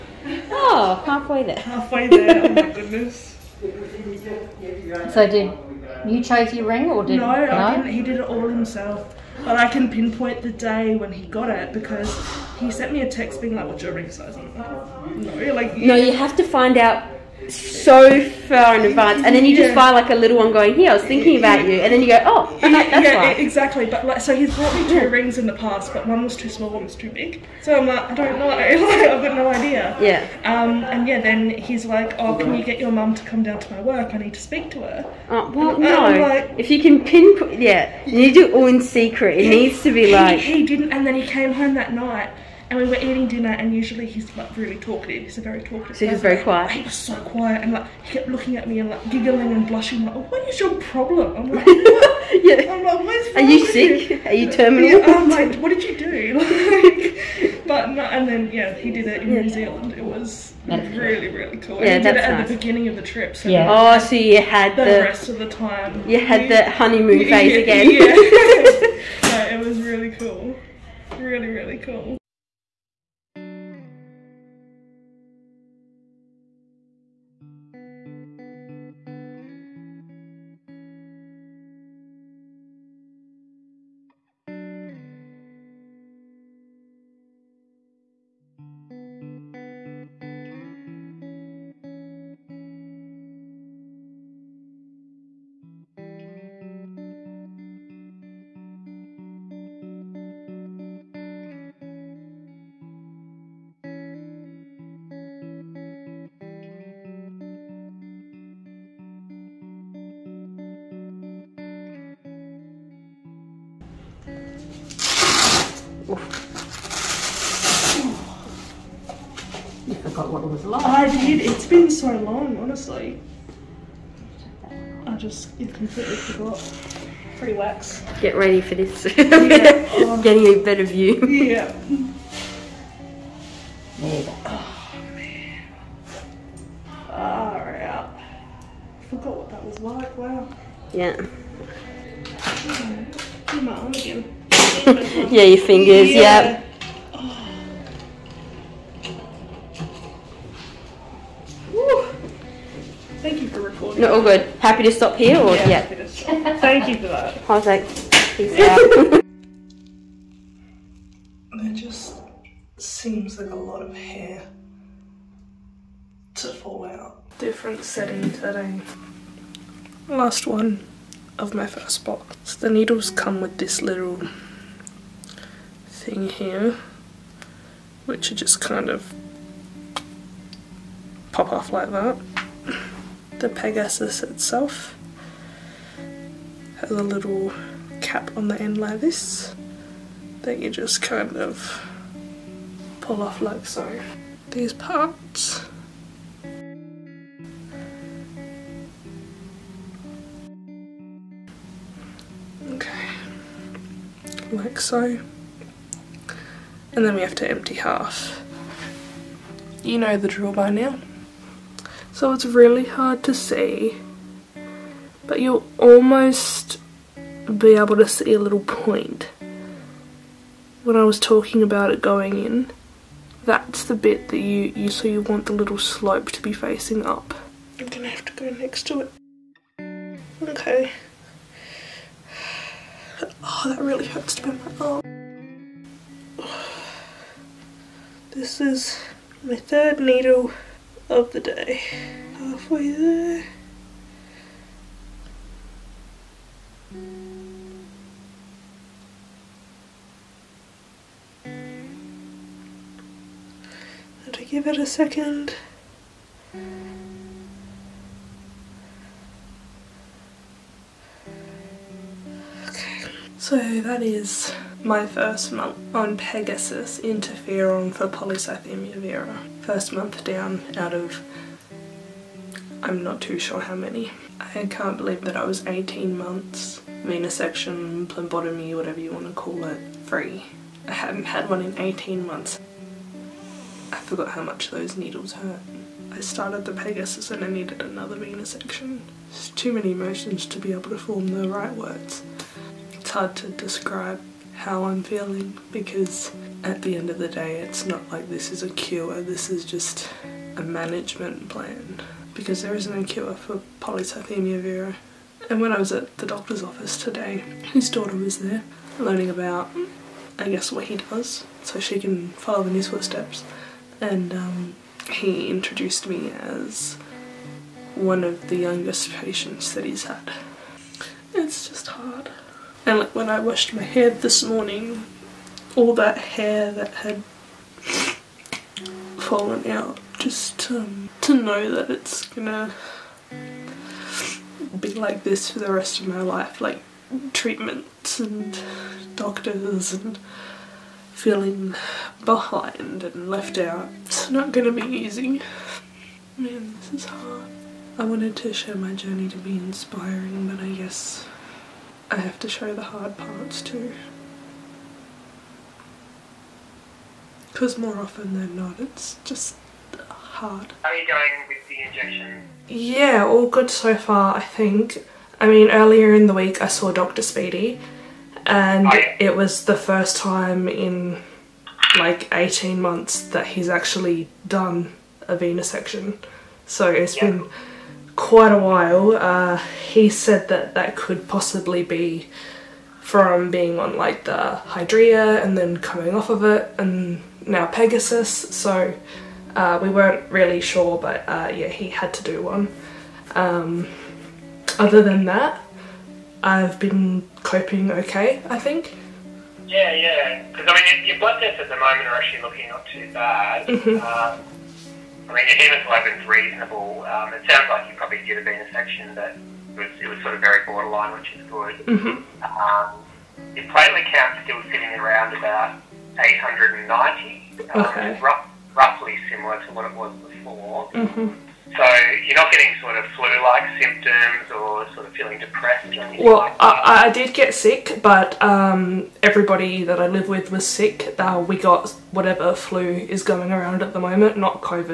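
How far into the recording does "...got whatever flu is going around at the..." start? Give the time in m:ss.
7:11.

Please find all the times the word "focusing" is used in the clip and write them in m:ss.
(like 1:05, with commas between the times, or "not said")
not said.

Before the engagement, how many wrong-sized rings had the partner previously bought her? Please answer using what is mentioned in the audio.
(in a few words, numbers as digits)
2.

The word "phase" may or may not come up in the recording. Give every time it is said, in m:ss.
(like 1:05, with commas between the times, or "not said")
1:07.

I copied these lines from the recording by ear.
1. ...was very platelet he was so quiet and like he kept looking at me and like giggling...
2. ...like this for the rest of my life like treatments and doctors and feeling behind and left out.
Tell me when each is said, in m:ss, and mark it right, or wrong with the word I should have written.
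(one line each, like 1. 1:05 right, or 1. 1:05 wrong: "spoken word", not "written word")
1. 0:46 wrong: "quiet", not "platelet"
2. 5:34 right.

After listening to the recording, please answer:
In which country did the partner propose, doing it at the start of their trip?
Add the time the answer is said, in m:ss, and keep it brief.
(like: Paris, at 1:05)
New Zealand, at 0:59.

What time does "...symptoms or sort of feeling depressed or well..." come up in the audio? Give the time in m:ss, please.
7:03.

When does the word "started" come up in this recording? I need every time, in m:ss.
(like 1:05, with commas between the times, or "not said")
4:46.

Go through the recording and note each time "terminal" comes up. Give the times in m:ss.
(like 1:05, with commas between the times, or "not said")
0:54.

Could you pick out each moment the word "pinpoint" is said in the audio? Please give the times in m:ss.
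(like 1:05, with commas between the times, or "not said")
0:09, 0:37.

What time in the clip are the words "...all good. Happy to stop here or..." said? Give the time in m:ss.
2:34.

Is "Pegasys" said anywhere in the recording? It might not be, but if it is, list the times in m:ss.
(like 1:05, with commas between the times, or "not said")
3:03, 4:26, 4:46, 6:27.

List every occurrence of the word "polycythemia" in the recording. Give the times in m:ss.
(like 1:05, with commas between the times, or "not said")
4:28, 5:03.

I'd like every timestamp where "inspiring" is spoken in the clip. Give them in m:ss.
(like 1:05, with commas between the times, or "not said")
5:49.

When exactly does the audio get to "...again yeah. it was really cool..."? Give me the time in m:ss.
1:07.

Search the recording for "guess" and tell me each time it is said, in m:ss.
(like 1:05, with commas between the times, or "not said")
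5:10, 5:50.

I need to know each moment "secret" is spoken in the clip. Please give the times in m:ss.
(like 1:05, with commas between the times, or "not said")
0:38.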